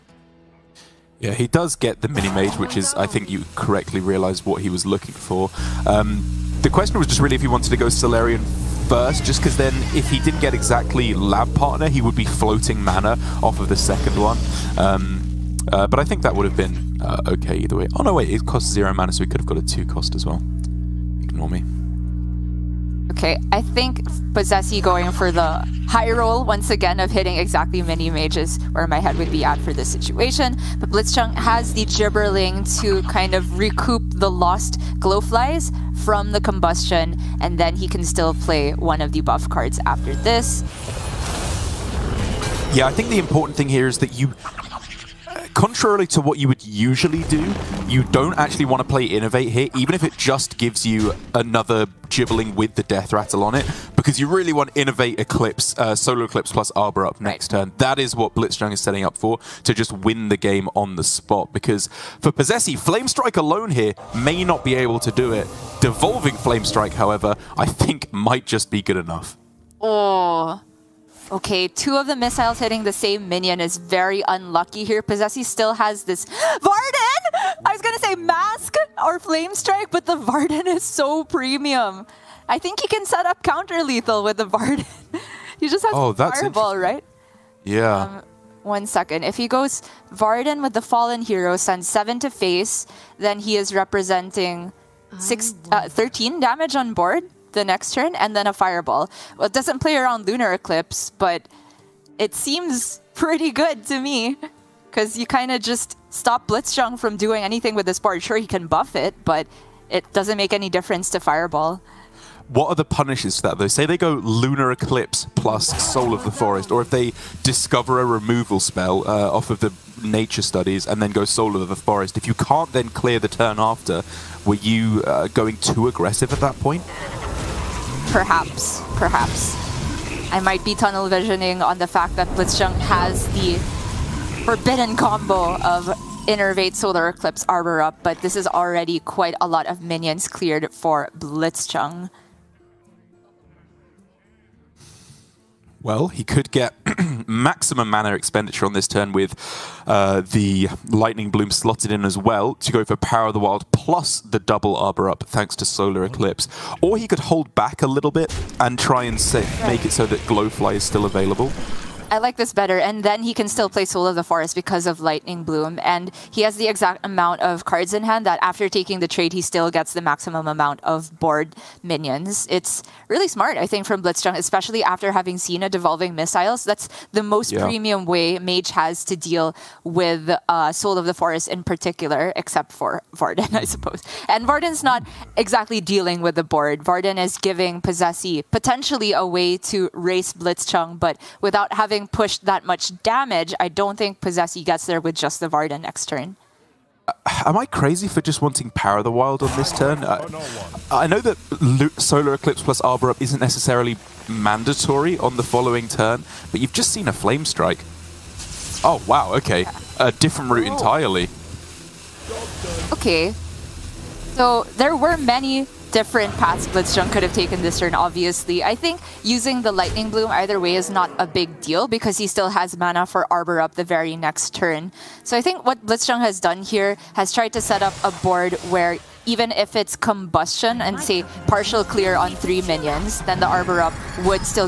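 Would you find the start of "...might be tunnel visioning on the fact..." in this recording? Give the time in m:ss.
2:10.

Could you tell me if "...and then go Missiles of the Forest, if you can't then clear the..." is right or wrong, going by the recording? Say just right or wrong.
wrong.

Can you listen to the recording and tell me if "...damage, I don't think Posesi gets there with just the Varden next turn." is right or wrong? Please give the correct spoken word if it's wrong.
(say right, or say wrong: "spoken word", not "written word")
right.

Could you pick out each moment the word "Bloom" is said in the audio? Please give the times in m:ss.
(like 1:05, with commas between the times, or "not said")
2:31, 2:45, 3:40.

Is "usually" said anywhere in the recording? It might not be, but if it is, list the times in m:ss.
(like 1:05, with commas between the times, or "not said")
0:46.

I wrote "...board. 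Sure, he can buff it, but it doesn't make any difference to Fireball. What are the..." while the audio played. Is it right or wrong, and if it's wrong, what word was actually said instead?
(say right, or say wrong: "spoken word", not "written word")
right.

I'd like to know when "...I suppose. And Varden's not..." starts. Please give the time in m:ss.
3:03.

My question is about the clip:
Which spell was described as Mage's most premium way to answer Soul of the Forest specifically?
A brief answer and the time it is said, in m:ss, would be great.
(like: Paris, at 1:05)
Devolving Missiles, at 2:55.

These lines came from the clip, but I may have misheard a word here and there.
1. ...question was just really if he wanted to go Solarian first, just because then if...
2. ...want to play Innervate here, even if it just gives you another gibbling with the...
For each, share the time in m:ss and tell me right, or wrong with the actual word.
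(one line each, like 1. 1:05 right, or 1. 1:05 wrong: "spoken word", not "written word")
1. 0:06 right
2. 0:48 right.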